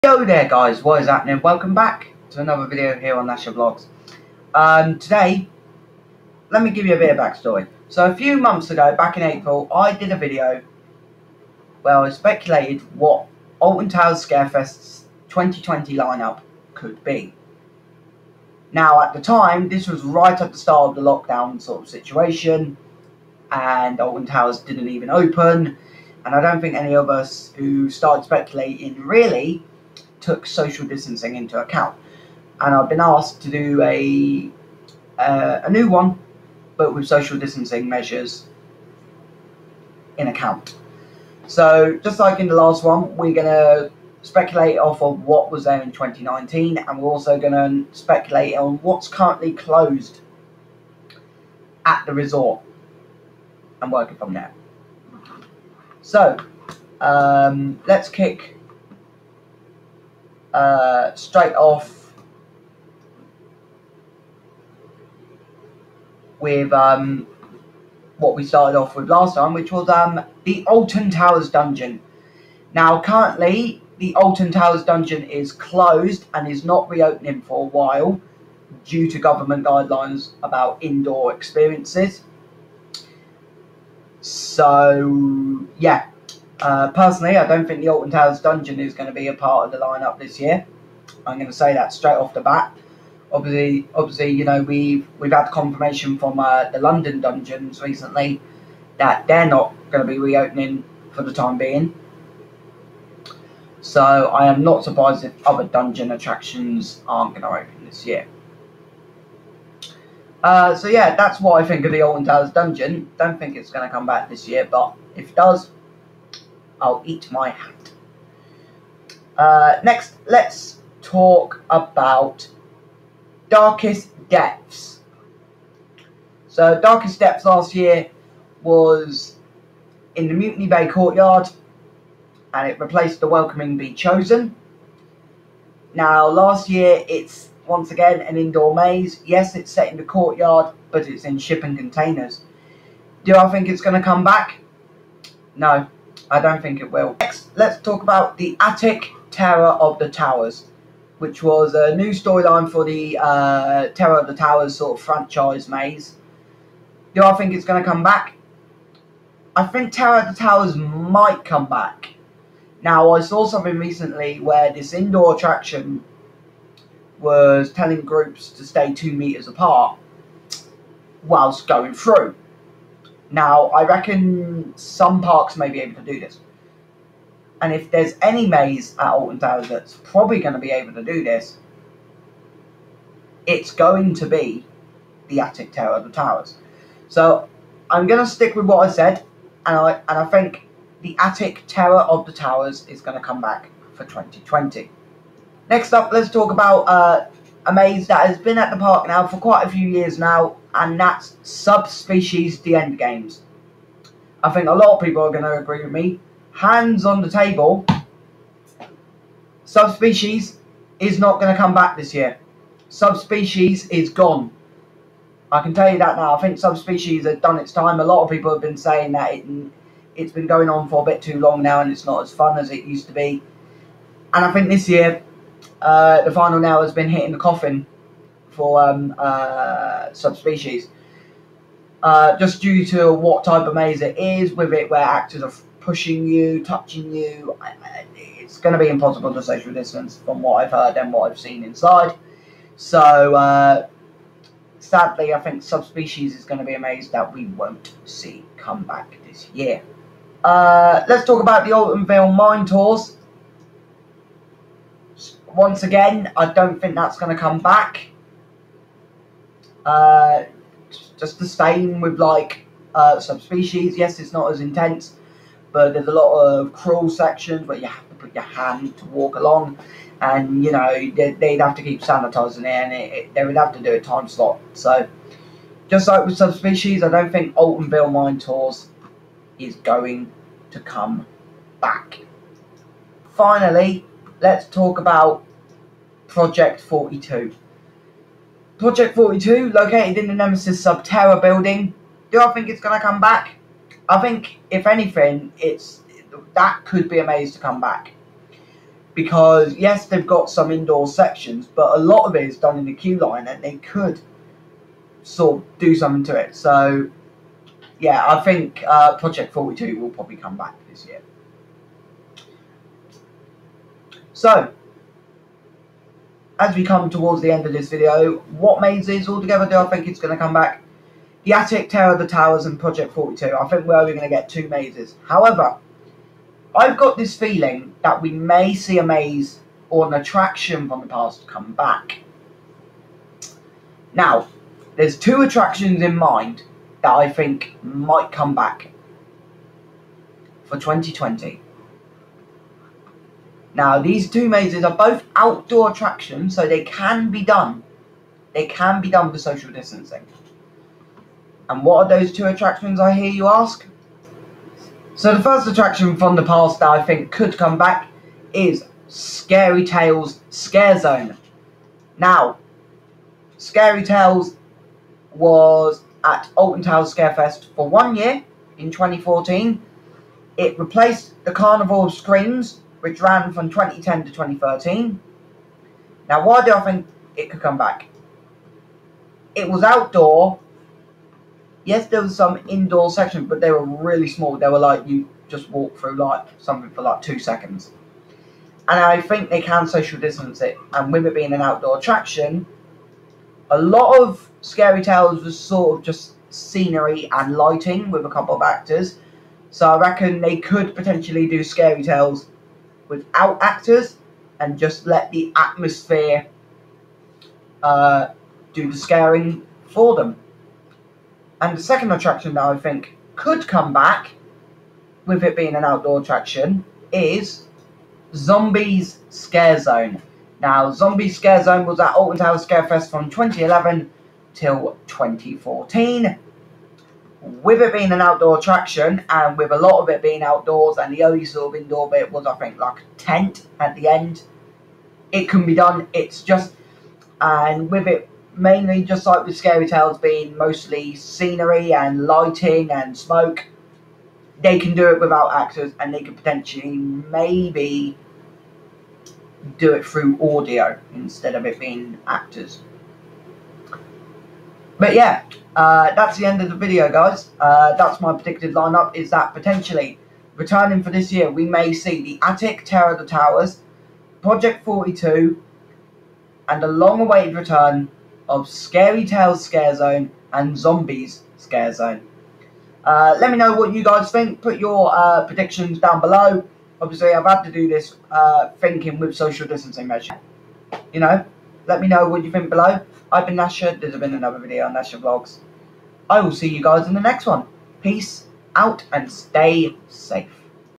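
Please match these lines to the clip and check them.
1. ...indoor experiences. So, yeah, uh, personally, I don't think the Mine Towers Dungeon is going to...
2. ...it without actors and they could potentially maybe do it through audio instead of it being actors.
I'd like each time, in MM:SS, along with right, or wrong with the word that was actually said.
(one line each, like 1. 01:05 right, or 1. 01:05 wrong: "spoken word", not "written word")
1. 01:20 wrong: "Alton", not "Mine"
2. 07:25 right.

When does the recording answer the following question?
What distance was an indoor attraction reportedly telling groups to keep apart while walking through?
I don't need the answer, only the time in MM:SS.
02:48.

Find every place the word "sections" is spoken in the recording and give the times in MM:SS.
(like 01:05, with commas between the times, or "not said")
04:27, 05:01, 06:23.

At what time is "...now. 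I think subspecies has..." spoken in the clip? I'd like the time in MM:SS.
03:36.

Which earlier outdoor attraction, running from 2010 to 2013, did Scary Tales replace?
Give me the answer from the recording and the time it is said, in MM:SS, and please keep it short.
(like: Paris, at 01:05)
Carnival of Screams, at 06:11.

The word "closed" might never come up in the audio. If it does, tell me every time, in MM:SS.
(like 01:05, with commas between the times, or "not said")
00:49, 01:15.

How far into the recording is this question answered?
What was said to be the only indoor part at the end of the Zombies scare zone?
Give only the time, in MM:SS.
07:12.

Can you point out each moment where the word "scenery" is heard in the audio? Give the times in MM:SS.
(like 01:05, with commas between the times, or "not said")
06:36, 07:21.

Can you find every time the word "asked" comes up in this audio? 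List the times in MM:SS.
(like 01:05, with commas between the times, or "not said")
00:33.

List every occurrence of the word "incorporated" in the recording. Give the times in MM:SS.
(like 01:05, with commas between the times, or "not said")
not said.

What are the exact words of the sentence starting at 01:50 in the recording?
Uh, so yeah, that's what I think of the Alton Towers Dungeon.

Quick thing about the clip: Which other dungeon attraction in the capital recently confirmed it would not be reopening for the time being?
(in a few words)
London Dungeons.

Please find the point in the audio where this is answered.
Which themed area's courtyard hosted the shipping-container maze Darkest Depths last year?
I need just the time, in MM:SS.
02:10.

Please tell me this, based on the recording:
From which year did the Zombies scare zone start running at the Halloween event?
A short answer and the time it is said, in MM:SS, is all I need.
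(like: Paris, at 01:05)
2011, at 07:03.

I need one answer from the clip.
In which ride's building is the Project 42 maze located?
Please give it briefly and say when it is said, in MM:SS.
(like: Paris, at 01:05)
Nemesis Subterra, at 04:50.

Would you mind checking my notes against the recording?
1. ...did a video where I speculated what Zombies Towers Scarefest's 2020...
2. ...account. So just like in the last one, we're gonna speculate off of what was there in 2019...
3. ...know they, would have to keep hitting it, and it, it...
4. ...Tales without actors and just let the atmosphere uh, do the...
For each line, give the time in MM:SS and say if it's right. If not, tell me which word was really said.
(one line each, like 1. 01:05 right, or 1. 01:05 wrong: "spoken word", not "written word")
1. 00:09 wrong: "Alton", not "Zombies"
2. 00:40 right
3. 04:30 wrong: "sanitizing", not "hitting"
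4. 06:42 right.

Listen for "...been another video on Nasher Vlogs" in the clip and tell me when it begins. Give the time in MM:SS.
08:04.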